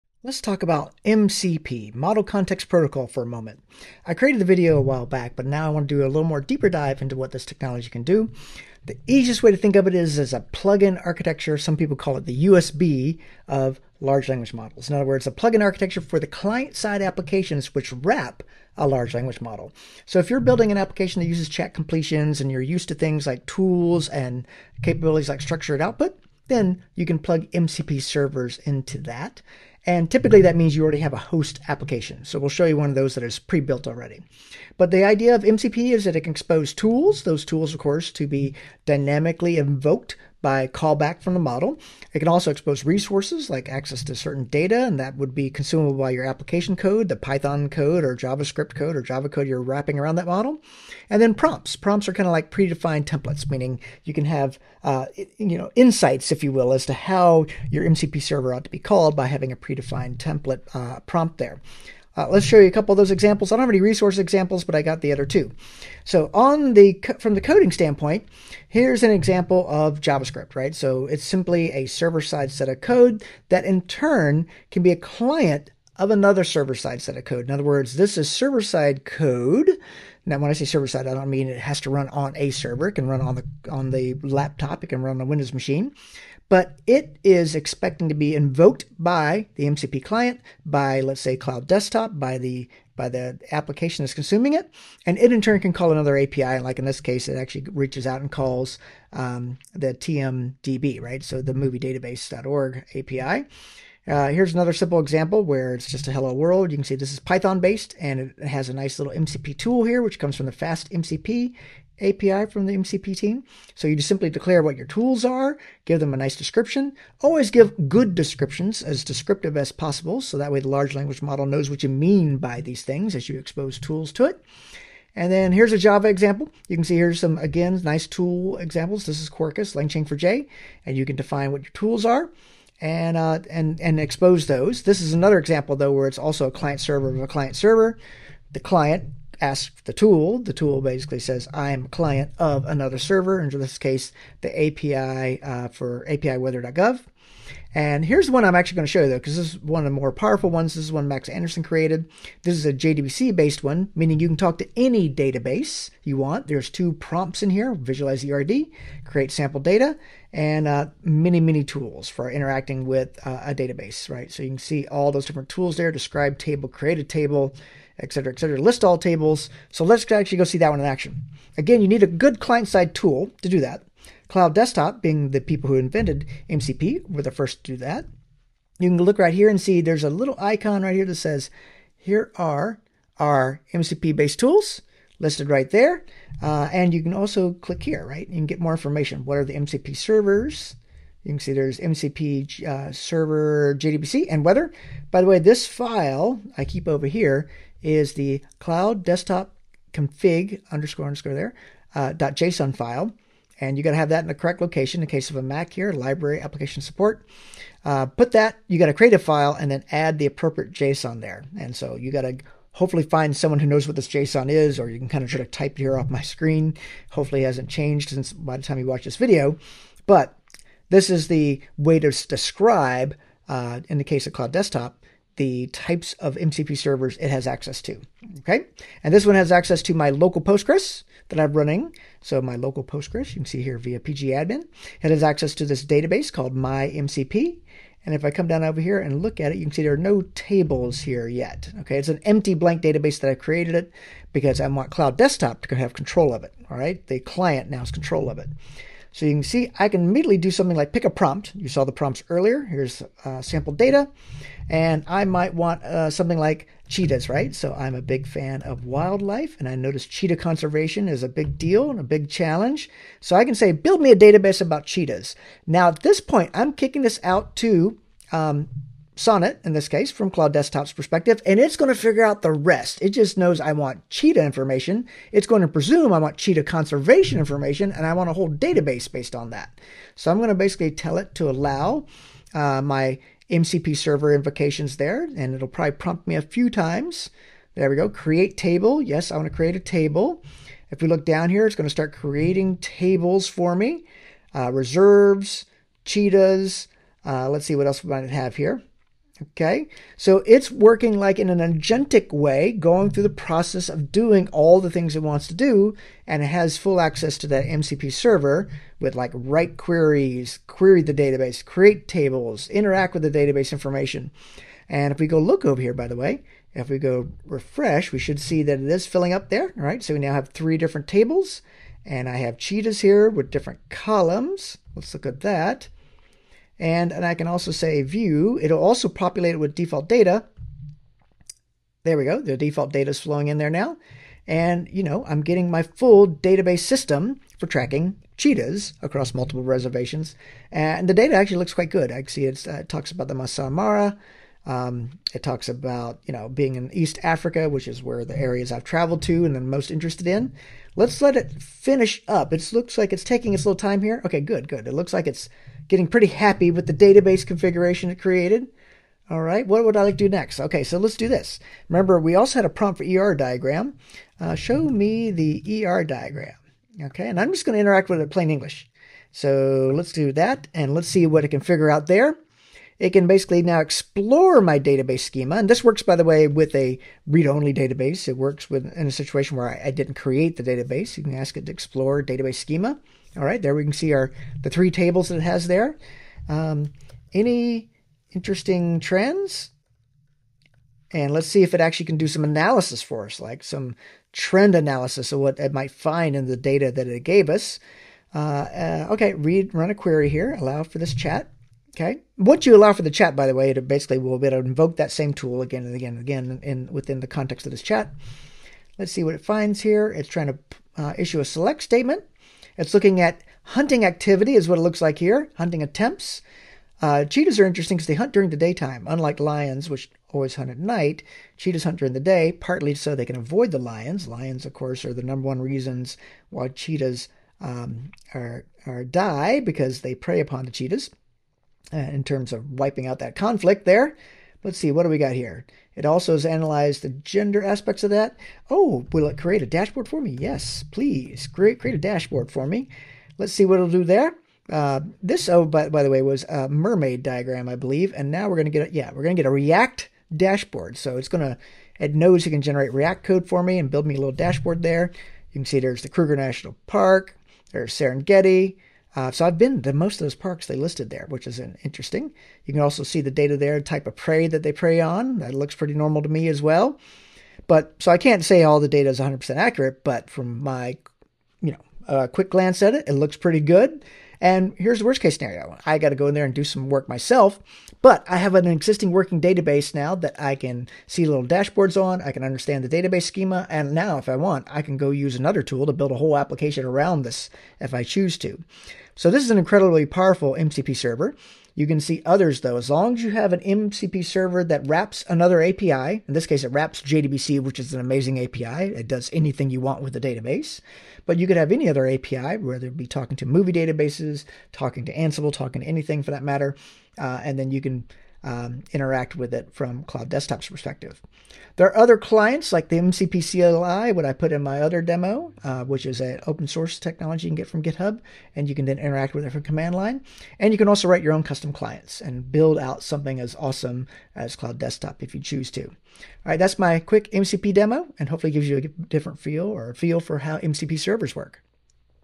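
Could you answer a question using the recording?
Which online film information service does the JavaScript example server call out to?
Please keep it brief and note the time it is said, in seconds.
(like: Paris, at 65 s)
TMDB, at 99 s.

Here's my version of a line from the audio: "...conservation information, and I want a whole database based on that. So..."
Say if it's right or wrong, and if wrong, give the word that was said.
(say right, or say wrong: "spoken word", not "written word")
right.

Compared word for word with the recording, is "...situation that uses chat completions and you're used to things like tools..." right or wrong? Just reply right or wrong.
wrong.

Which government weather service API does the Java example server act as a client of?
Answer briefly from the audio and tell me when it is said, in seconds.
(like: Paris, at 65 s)
apiweather.gov, at 146 s.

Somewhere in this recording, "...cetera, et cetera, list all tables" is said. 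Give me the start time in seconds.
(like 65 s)
168 s.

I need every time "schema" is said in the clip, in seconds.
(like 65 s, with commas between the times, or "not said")
375 s, 382 s, 483 s.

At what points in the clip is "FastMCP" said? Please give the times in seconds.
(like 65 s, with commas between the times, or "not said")
110 s.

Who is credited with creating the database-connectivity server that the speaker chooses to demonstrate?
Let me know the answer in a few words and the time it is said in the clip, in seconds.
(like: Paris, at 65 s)
Max Andersen, at 151 s.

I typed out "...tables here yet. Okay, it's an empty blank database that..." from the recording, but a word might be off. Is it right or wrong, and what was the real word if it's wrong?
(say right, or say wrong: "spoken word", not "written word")
right.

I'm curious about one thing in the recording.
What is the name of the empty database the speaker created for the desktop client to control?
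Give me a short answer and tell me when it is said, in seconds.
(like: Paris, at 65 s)
MyMCP, at 236 s.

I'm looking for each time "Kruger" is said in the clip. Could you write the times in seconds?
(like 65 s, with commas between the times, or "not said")
456 s.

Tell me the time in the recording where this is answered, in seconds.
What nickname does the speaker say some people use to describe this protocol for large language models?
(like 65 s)
12 s.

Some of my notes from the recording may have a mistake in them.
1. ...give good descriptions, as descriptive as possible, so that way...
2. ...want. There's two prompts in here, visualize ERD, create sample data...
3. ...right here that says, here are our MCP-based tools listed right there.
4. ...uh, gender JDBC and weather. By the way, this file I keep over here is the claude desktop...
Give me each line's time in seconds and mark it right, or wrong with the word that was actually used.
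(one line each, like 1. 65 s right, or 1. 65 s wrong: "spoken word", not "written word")
1. 117 s right
2. 156 s right
3. 180 s right
4. 192 s wrong: "server", not "gender".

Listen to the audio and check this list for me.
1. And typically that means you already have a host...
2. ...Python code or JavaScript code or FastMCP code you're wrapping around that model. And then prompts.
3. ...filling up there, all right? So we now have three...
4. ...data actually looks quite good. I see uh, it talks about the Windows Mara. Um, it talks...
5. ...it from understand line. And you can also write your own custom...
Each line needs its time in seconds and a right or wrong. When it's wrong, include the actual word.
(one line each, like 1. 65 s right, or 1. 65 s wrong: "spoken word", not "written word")
1. 29 s right
2. 47 s wrong: "Java", not "FastMCP"
3. 319 s right
4. 341 s wrong: "Masai", not "Windows"
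5. 519 s wrong: "command", not "understand".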